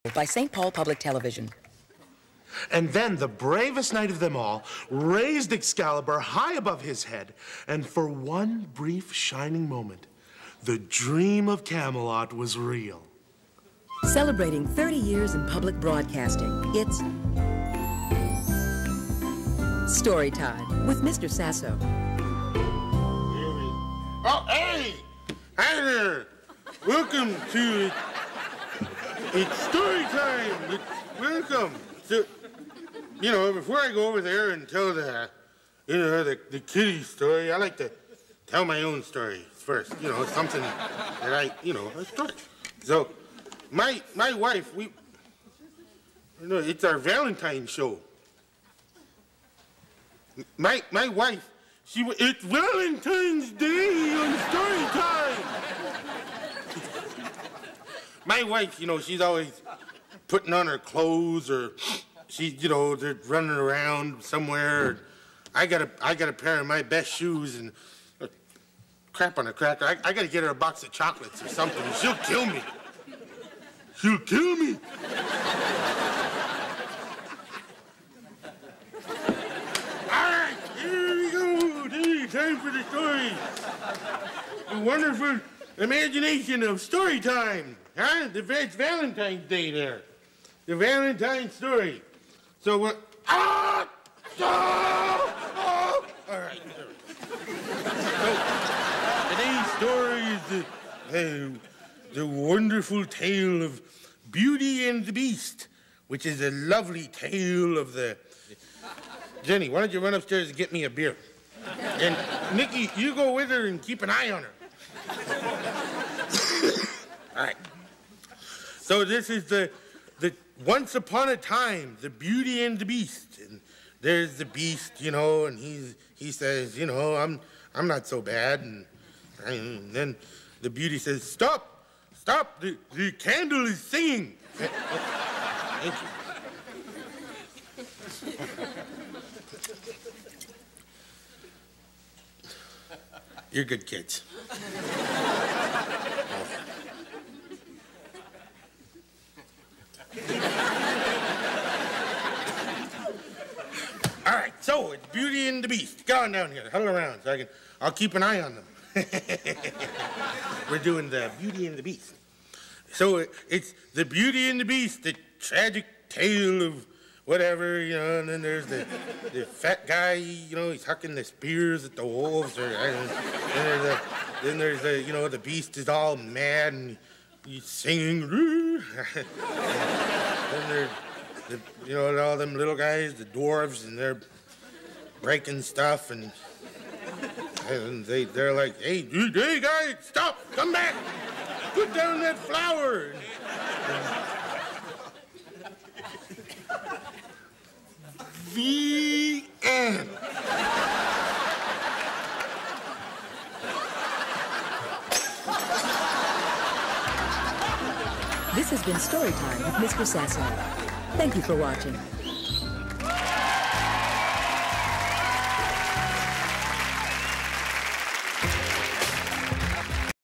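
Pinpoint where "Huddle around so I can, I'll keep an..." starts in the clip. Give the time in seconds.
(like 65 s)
156 s.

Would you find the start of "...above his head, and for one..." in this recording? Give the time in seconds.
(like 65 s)
6 s.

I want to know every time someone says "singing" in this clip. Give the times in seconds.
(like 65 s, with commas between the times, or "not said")
133 s, 177 s.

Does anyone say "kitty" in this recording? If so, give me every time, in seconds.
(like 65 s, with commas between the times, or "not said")
36 s.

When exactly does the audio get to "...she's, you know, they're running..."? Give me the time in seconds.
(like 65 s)
62 s.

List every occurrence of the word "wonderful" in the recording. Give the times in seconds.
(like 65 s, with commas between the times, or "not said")
84 s, 102 s.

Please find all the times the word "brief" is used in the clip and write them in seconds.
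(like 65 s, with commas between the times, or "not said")
8 s.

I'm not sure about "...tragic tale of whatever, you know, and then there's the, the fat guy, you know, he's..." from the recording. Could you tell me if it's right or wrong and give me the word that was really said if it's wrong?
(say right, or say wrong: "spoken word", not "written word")
right.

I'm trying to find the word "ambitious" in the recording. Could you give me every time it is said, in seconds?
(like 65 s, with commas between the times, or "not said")
not said.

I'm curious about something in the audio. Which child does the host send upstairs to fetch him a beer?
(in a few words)
Jenny.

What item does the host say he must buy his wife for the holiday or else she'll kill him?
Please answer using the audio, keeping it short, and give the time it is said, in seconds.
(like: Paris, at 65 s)
box of chocolates, at 70 s.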